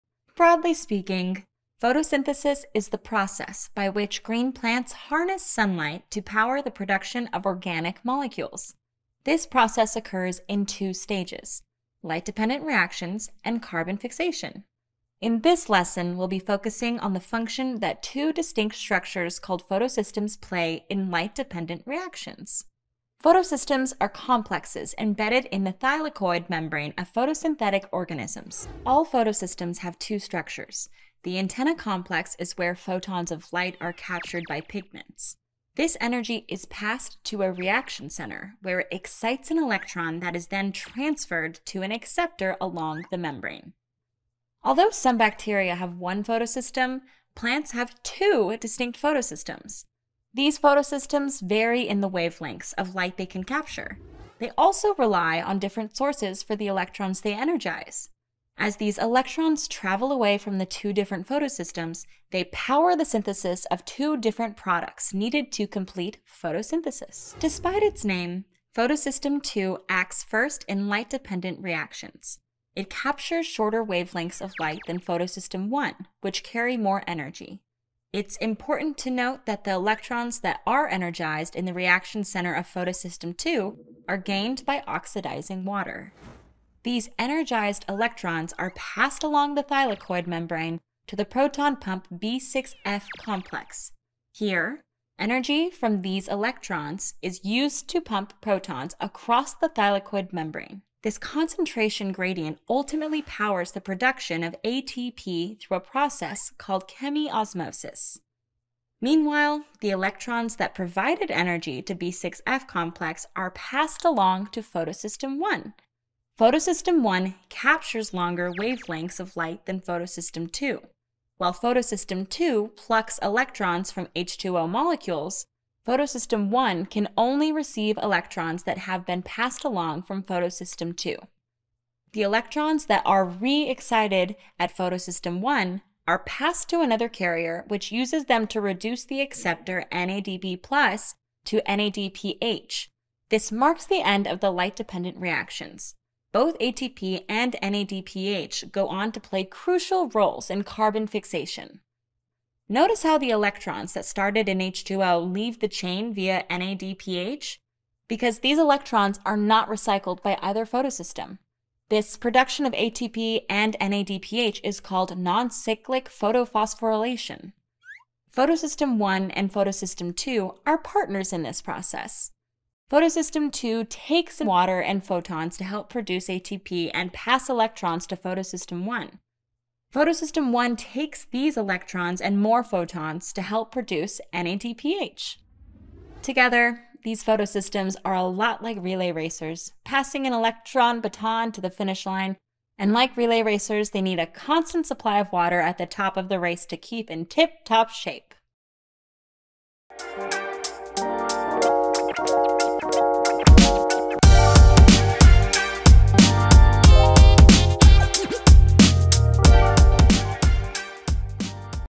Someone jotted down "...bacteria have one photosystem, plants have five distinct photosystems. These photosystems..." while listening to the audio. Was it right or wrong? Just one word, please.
wrong.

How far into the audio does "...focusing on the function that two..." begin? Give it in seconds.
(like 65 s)
16 s.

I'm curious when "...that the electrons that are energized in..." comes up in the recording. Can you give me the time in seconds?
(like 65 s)
79 s.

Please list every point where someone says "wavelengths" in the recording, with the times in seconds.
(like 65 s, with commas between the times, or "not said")
52 s, 73 s, 118 s.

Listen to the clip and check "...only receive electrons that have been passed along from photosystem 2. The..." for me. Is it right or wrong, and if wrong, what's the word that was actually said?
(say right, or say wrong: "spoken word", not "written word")
right.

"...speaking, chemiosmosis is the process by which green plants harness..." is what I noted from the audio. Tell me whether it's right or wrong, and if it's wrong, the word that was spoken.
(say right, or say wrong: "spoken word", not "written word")
wrong: "photosynthesis", not "chemiosmosis".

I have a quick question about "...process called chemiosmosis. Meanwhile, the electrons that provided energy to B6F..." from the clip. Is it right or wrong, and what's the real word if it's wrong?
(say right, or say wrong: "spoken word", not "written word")
right.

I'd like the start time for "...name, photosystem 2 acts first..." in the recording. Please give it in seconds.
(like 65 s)
68 s.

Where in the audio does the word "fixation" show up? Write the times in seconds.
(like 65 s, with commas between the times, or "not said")
13 s, 151 s.